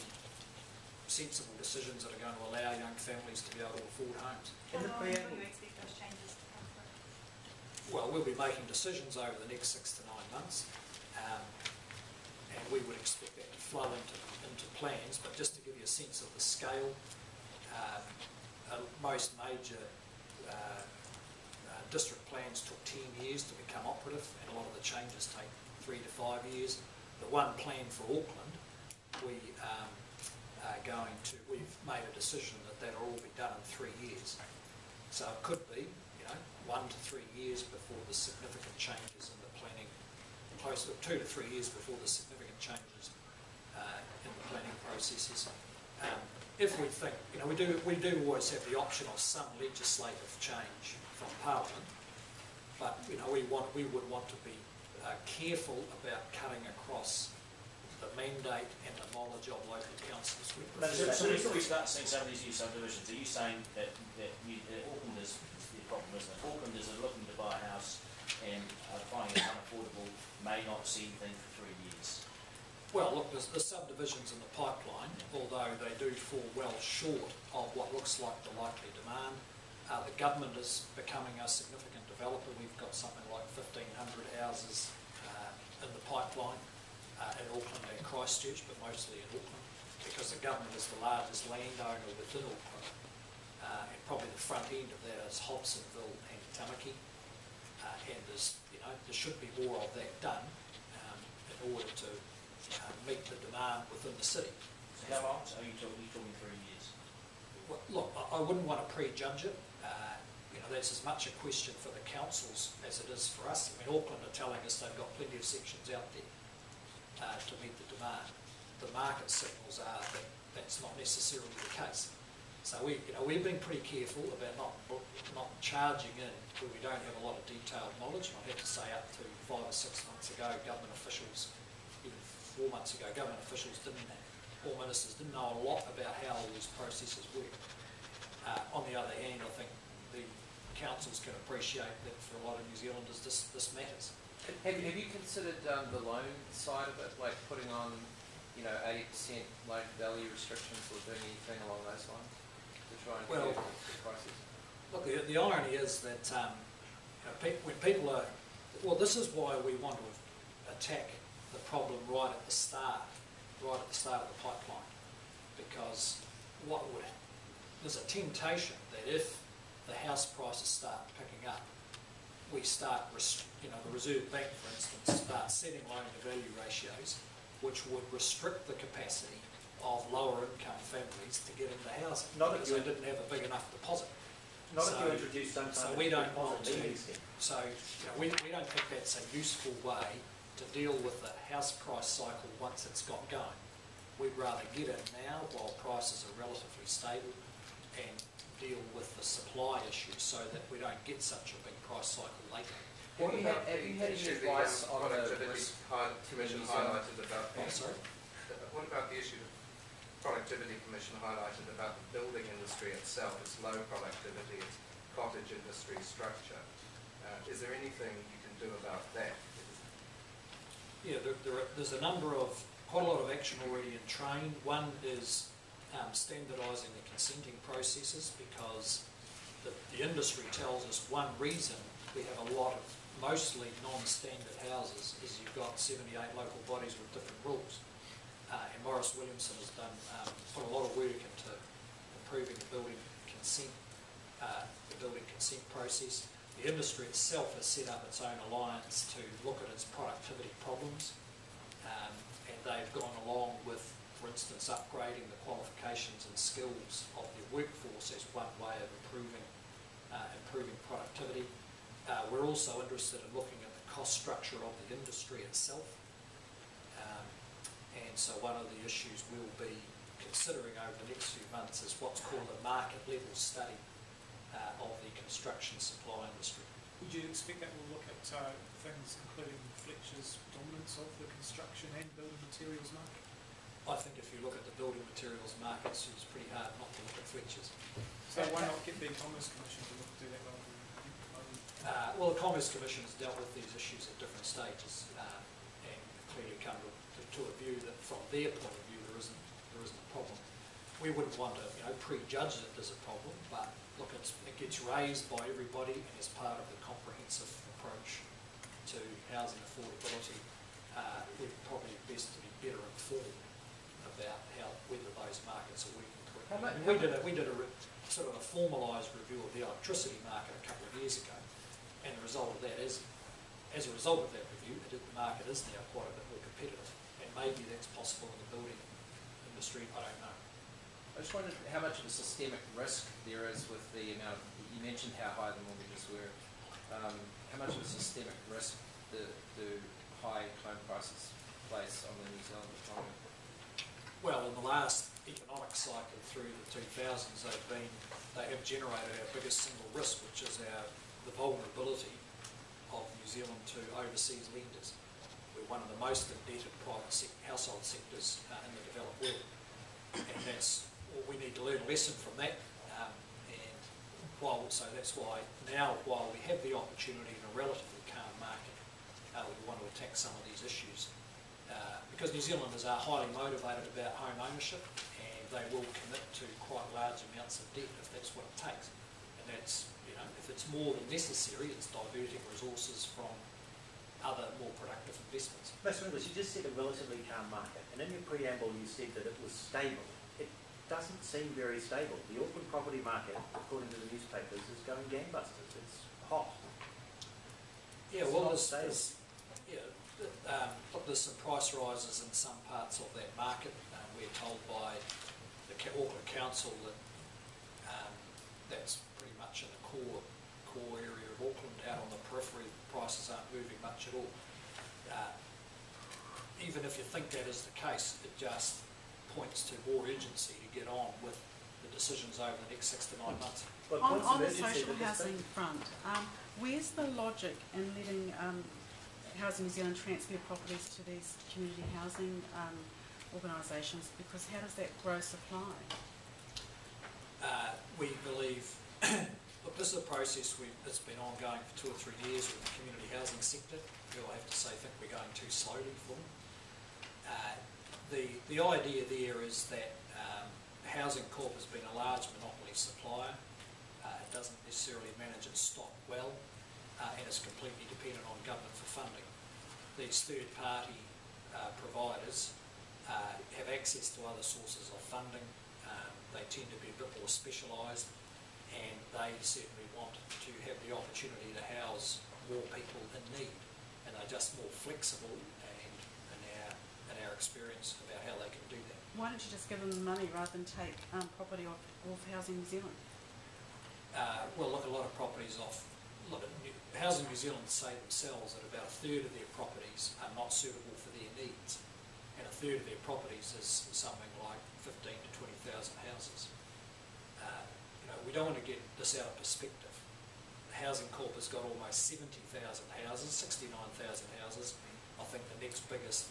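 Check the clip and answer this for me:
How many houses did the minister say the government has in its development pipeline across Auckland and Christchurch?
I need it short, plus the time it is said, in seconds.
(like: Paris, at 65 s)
1,500, at 83 s.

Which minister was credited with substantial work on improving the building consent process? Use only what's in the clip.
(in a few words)
Maurice Williamson.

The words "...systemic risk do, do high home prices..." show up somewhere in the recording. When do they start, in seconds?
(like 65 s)
337 s.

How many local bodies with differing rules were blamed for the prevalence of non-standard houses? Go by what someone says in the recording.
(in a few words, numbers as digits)
78.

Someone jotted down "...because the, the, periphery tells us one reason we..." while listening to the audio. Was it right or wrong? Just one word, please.
wrong.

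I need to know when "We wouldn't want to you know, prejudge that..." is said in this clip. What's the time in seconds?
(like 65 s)
300 s.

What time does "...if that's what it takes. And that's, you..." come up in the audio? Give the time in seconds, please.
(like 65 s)
378 s.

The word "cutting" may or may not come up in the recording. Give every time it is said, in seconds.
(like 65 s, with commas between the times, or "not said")
56 s.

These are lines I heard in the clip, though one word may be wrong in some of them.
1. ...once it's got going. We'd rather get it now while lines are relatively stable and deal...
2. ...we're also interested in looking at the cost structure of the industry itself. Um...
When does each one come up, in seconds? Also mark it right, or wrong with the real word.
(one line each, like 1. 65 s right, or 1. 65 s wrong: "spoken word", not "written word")
1. 192 s wrong: "prices", not "lines"
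2. 262 s right.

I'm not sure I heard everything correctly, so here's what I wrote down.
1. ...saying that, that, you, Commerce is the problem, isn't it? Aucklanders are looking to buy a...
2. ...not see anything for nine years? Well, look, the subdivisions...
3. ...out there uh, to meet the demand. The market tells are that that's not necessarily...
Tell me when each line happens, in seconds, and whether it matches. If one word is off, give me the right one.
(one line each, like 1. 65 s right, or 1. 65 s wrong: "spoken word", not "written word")
1. 63 s wrong: "Auckland", not "Commerce"
2. 70 s wrong: "three", not "nine"
3. 115 s wrong: "signals", not "tells".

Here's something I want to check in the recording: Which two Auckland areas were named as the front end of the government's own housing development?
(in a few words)
Hobsonville and Tamaki.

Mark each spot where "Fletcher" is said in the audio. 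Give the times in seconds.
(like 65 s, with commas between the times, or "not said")
279 s, 287 s.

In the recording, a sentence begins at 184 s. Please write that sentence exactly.
Not so, if you introduce some kind so we don't want to.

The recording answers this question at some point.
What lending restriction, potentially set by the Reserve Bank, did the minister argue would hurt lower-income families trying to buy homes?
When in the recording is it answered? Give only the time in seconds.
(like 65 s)
175 s.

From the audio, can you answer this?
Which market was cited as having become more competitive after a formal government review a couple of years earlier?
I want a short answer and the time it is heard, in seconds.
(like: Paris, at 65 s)
Electricity market, at 319 s.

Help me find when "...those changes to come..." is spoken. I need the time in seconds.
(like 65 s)
5 s.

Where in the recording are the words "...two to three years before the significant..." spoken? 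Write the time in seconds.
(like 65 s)
41 s.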